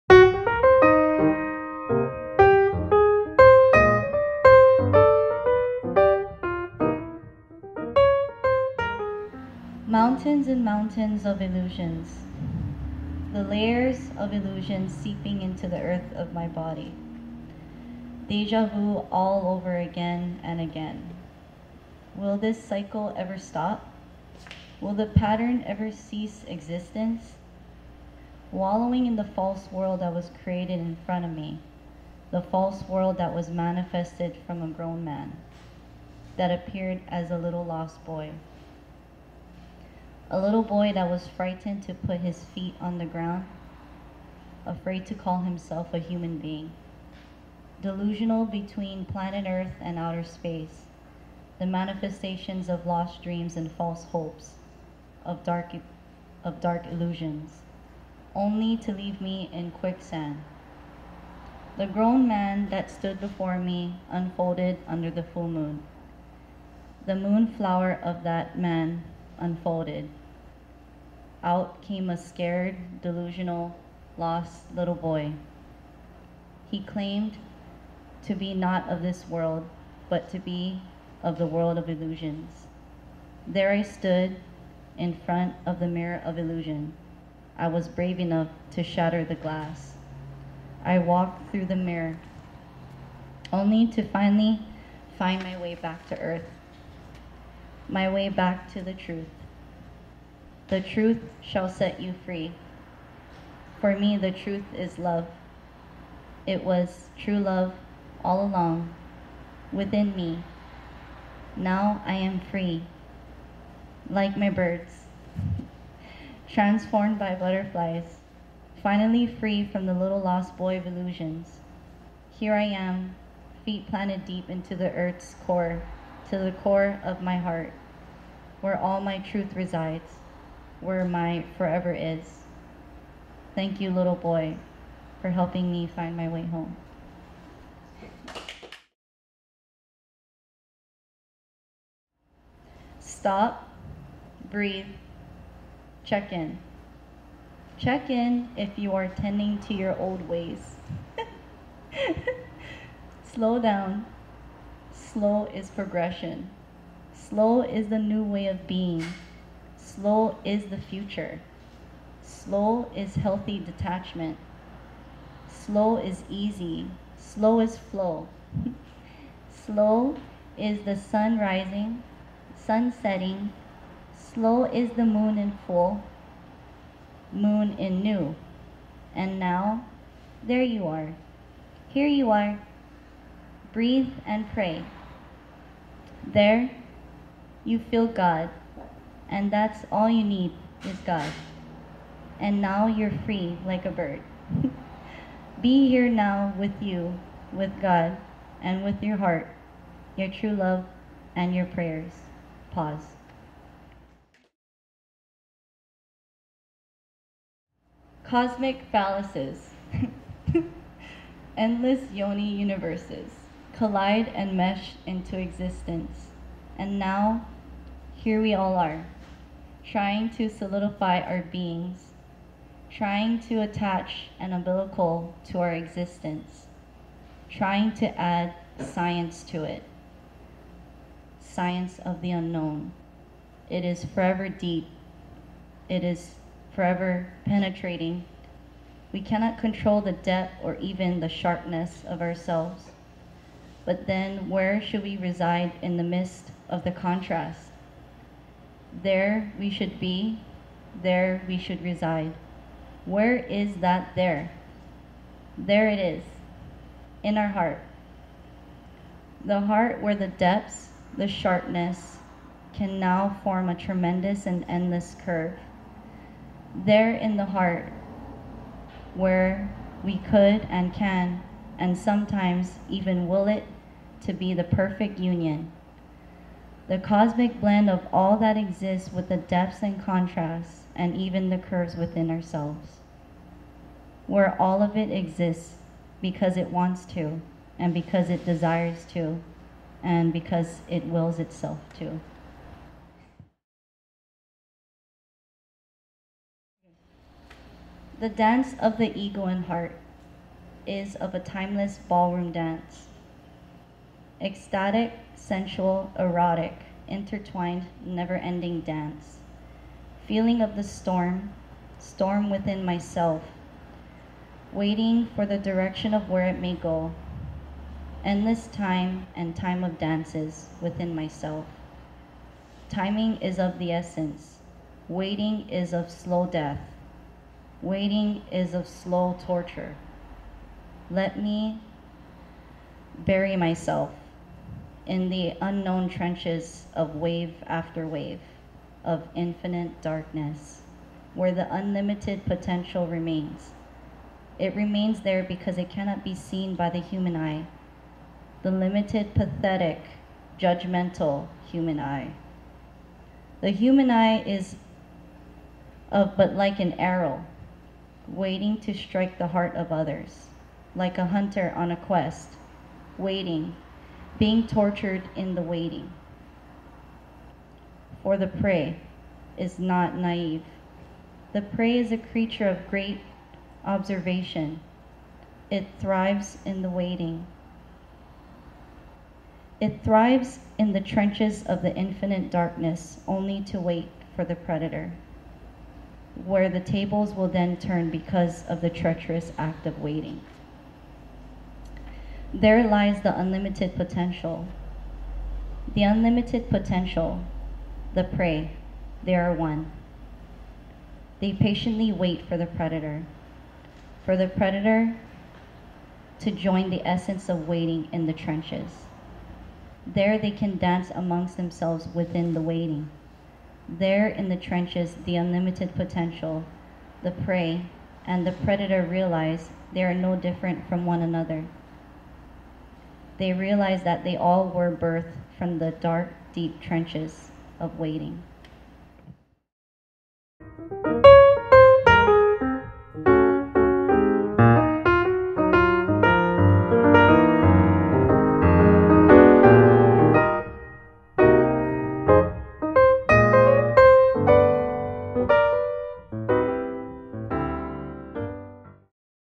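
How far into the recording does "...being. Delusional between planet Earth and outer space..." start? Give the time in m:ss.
0:46.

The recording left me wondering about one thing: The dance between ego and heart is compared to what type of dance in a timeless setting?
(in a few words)
ballroom dance.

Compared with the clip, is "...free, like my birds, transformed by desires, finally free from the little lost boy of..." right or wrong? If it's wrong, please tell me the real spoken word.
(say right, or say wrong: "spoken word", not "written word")
wrong: "butterflies", not "desires".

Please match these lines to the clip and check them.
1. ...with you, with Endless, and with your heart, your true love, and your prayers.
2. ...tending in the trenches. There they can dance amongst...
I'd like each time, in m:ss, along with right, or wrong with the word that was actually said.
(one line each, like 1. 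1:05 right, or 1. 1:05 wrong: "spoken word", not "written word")
1. 3:16 wrong: "God", not "Endless"
2. 6:47 wrong: "waiting", not "tending".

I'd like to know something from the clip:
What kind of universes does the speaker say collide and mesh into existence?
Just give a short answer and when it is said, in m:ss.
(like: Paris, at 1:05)
endless yoni universes, at 3:31.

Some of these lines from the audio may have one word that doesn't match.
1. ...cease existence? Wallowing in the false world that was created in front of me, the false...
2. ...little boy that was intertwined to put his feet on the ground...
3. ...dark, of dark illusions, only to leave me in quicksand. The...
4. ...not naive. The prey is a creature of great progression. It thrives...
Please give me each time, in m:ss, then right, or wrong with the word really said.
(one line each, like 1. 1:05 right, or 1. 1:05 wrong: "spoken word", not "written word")
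1. 0:25 right
2. 0:40 wrong: "frightened", not "intertwined"
3. 0:55 right
4. 6:09 wrong: "observation", not "progression".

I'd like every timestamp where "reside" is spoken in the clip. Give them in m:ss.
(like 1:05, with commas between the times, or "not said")
2:09, 4:05, 4:11.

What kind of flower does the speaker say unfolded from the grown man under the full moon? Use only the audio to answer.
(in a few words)
moon flower.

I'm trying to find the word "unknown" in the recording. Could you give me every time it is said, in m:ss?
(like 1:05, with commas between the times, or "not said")
3:52, 5:35.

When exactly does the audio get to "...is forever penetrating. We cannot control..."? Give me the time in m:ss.
3:56.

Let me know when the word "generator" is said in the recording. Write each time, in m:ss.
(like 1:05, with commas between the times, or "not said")
not said.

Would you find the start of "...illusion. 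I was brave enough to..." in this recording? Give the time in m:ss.
1:26.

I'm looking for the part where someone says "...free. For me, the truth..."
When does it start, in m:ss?
1:42.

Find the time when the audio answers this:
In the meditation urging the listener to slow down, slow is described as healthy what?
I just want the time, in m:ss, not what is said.
2:43.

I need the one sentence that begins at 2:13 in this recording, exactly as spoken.
Thank you, little boy, for helping me find my way home.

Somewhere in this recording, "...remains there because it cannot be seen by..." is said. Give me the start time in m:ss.
5:44.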